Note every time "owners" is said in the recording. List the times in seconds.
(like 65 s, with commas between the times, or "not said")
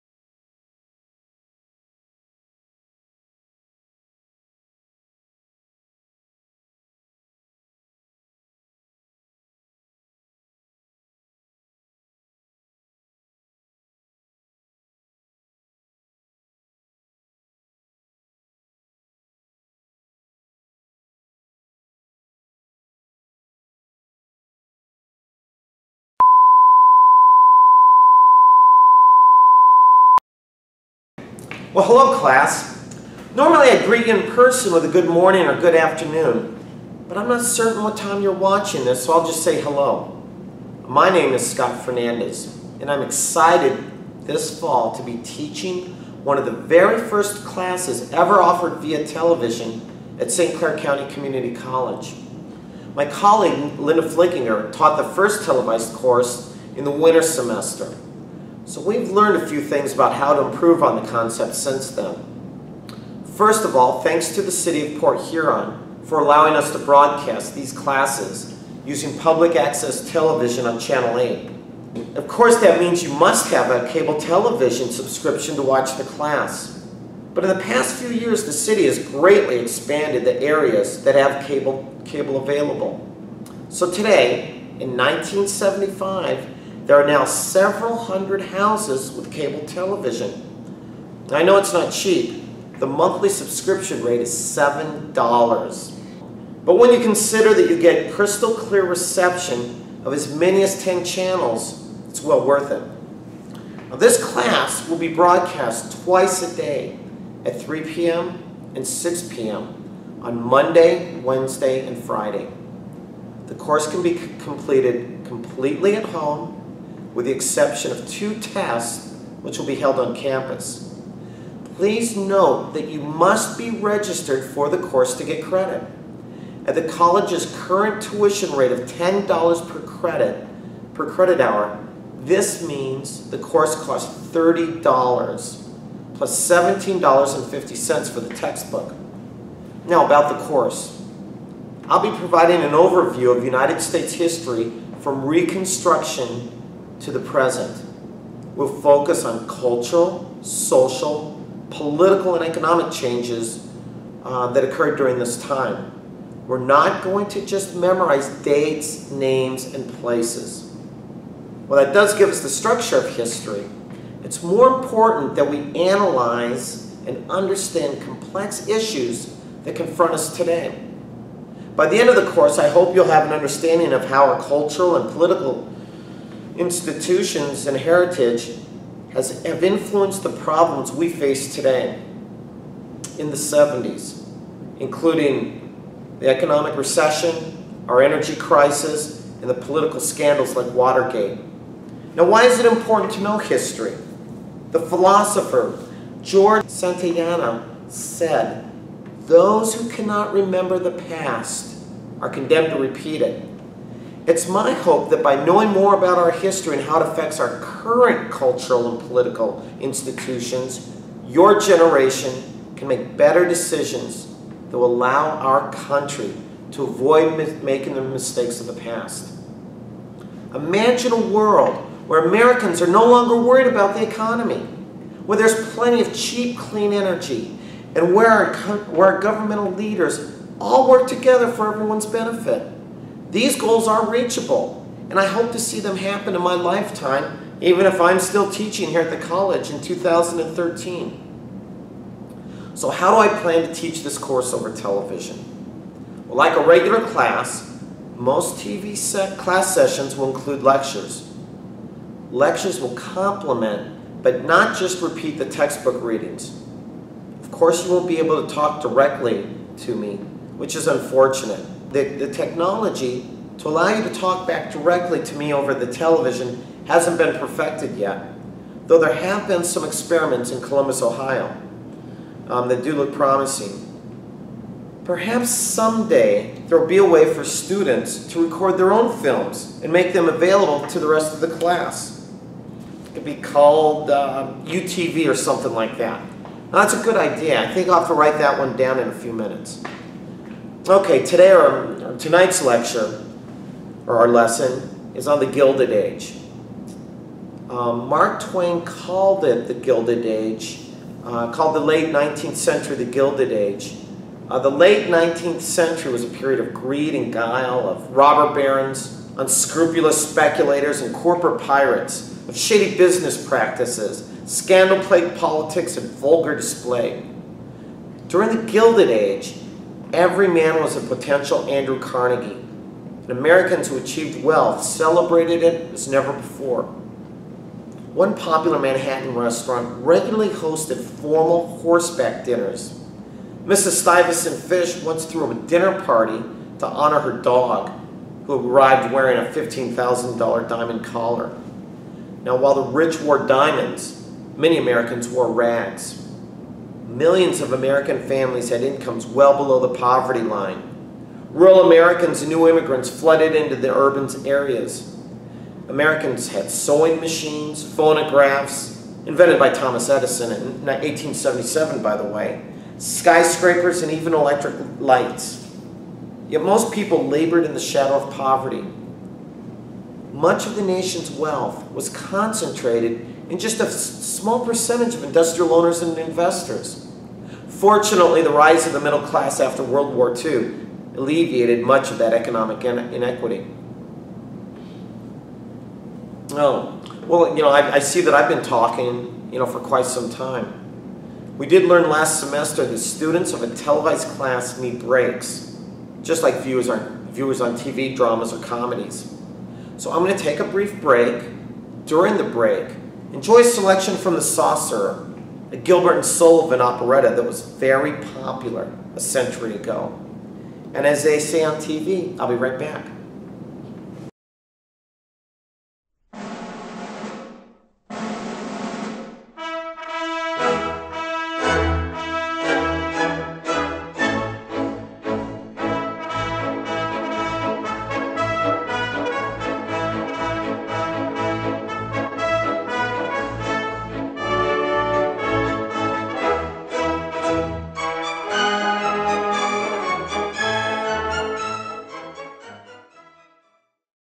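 375 s.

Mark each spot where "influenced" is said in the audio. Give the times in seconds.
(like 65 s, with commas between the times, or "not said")
179 s.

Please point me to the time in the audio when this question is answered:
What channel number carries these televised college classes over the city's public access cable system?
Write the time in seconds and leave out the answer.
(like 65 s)
70 s.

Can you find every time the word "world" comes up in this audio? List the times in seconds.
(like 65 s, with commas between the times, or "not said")
221 s, 379 s.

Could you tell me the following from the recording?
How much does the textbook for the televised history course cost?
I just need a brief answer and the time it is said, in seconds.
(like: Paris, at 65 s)
$17.50, at 136 s.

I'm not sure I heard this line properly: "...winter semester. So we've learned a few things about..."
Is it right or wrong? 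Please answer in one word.
right.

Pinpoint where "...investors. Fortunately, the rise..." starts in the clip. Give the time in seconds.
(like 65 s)
376 s.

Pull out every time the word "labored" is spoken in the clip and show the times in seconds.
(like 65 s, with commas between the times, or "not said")
367 s.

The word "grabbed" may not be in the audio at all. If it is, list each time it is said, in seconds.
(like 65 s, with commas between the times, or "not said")
not said.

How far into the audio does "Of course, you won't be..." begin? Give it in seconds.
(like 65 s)
257 s.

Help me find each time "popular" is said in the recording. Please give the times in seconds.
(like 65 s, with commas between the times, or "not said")
328 s, 408 s.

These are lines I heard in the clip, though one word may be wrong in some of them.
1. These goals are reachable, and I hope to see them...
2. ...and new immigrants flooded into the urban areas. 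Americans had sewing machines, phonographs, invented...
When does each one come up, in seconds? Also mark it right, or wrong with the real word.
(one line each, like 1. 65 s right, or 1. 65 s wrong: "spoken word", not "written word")
1. 233 s right
2. 352 s right.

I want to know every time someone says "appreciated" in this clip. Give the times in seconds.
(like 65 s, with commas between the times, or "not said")
not said.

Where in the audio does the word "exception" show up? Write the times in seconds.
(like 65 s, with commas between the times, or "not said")
117 s.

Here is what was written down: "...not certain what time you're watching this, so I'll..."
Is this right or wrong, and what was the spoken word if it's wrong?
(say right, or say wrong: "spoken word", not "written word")
right.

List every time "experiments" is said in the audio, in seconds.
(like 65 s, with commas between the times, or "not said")
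269 s.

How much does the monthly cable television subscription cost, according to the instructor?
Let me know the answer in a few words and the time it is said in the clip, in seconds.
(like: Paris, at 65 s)
$7, at 94 s.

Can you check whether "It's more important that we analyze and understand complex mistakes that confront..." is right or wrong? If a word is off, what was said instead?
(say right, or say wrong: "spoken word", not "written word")
wrong: "issues", not "mistakes".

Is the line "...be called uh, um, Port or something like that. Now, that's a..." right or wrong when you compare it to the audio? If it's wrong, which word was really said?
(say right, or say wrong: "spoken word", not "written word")
wrong: "UTV", not "Port".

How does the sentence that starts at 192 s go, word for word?
Now, why is it important to know history?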